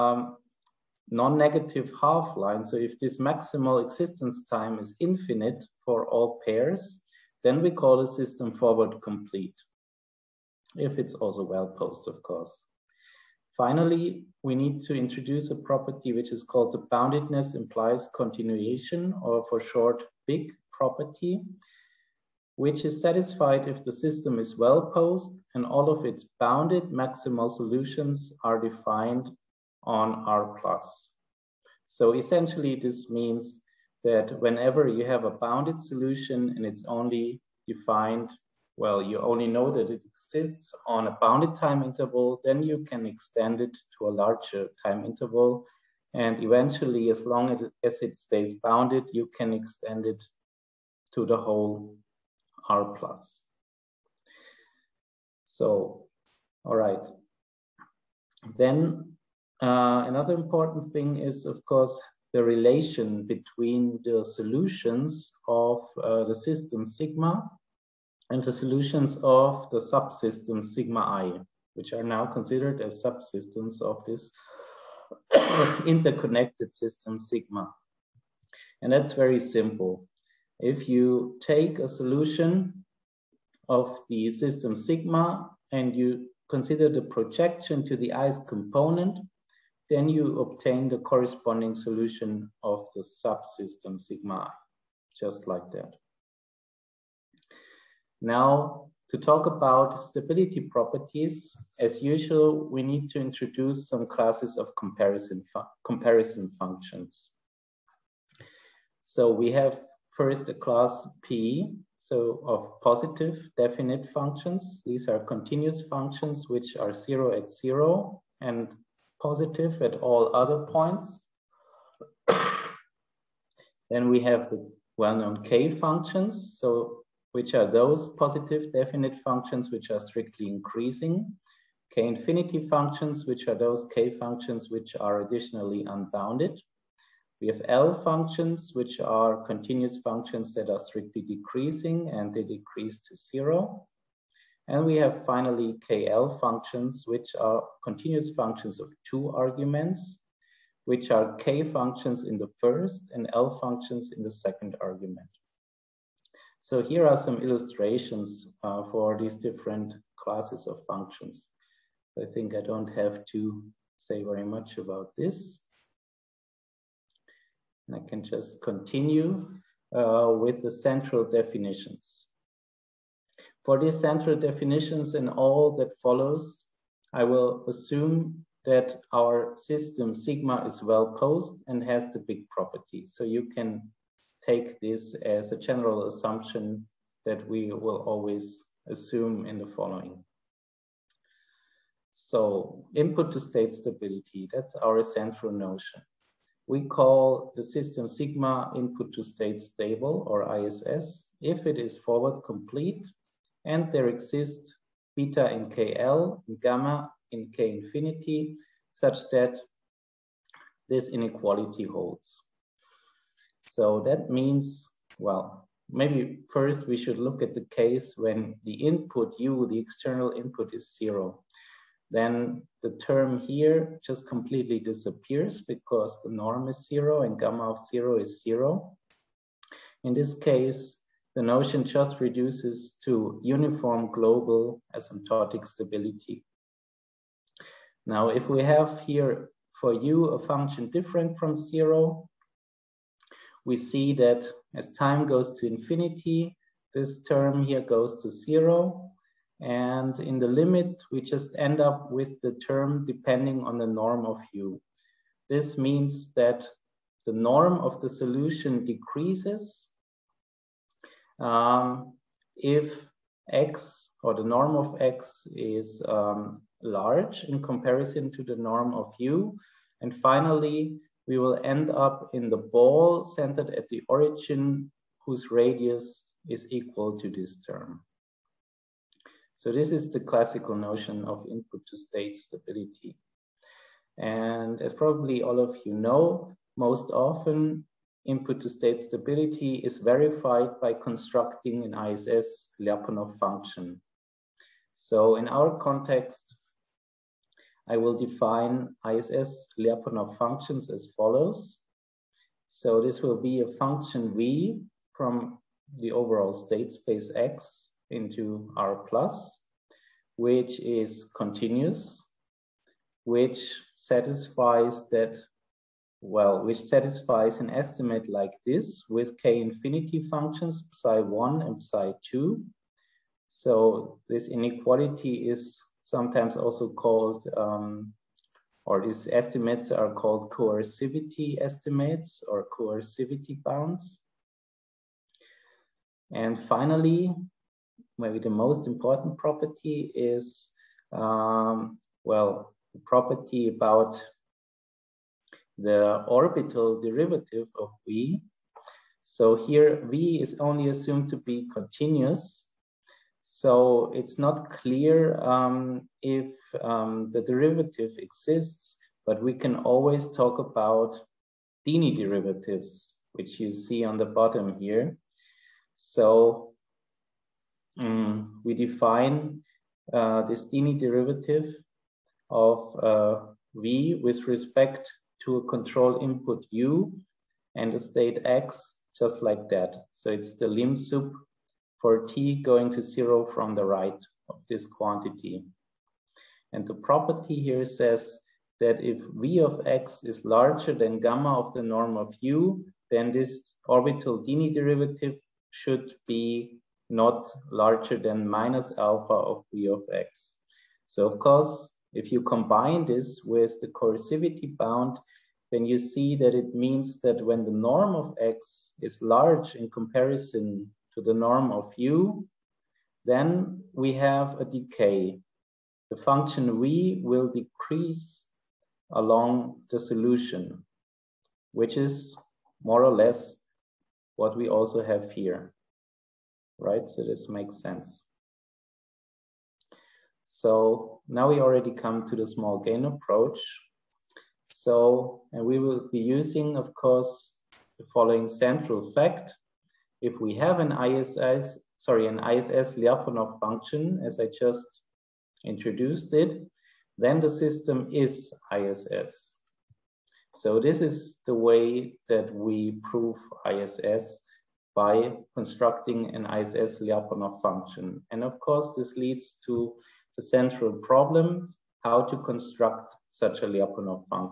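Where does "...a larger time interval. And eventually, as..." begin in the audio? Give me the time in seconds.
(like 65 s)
44 s.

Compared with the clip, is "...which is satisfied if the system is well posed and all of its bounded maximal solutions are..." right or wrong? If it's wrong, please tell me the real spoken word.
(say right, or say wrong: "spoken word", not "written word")
right.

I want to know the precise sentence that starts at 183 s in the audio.
So you can take this as a general assumption that we will always assume in the following.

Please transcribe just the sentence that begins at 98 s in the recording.
Now, to talk about stability properties, as usual, we need to introduce some classes of comparison, fu comparison functions.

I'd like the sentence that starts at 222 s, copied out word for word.
Then the term here just completely disappears because the norm is zero and gamma of zero is zero.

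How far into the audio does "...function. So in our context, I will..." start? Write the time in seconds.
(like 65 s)
293 s.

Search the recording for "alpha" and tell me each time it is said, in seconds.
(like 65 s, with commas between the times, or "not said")
398 s.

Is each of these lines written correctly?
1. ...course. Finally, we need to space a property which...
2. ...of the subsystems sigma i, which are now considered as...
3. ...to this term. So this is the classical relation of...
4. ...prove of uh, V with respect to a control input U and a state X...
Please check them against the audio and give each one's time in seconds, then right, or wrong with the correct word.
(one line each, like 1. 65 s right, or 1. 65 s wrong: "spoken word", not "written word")
1. 12 s wrong: "introduce", not "space"
2. 69 s right
3. 277 s wrong: "notion", not "relation"
4. 370 s wrong: "derivative", not "prove".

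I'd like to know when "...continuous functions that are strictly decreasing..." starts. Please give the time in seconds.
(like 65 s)
139 s.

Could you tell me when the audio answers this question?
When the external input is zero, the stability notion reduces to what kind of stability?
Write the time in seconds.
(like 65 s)
233 s.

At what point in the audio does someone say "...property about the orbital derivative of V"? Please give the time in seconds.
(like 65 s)
342 s.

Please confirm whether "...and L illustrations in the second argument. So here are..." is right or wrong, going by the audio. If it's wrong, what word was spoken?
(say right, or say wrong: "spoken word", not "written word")
wrong: "functions", not "illustrations".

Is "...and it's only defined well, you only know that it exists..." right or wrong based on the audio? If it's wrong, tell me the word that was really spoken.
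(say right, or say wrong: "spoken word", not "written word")
right.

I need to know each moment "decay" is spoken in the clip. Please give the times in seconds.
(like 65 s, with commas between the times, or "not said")
414 s.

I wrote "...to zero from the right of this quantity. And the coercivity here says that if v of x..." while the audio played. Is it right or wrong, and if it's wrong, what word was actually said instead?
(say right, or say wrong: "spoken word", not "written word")
wrong: "property", not "coercivity".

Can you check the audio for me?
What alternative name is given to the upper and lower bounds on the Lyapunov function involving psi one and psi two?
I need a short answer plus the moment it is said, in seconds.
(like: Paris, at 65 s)
coercivity estimates, at 330 s.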